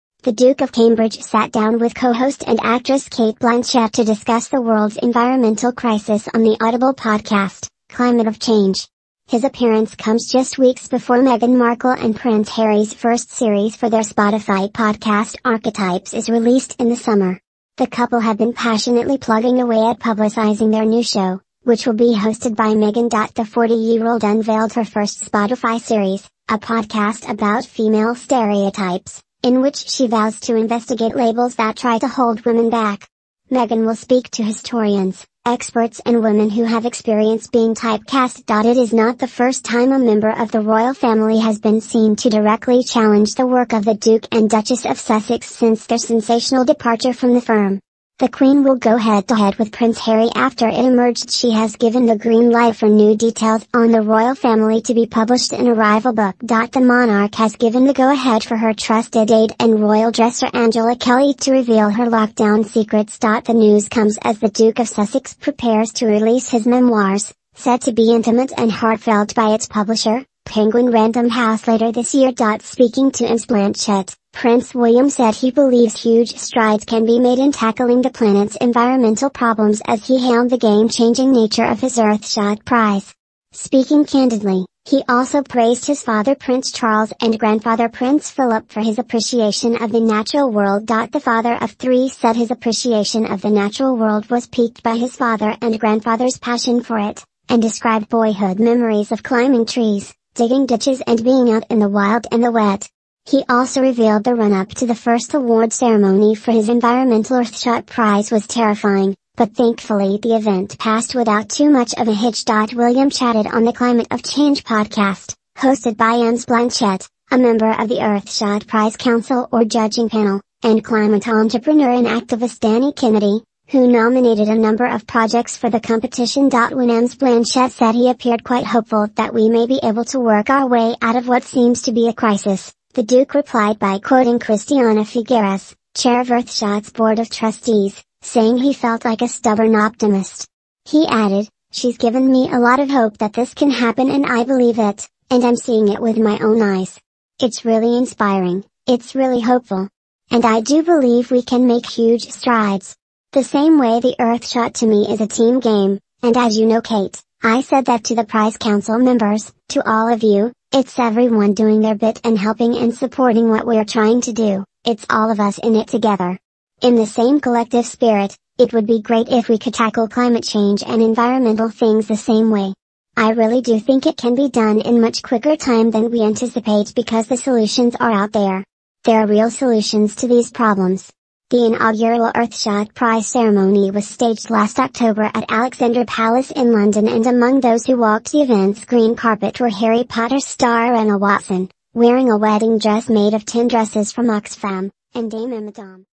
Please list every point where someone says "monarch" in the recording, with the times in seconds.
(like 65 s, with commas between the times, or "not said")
56 s.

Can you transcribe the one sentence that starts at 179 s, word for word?
There are real solutions to these problems.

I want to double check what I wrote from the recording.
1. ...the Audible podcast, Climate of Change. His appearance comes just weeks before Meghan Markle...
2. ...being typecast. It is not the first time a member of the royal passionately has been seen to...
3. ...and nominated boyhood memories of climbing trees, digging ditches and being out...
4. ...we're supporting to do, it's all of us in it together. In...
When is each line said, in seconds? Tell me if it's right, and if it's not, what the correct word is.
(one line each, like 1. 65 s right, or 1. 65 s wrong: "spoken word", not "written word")
1. 6 s right
2. 37 s wrong: "family", not "passionately"
3. 97 s wrong: "described", not "nominated"
4. 163 s wrong: "trying", not "supporting".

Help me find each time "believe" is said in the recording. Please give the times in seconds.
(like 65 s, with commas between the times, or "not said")
75 s, 144 s, 150 s.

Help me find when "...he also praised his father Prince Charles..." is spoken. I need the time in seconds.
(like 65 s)
84 s.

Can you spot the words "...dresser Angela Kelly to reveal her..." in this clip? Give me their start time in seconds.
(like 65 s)
60 s.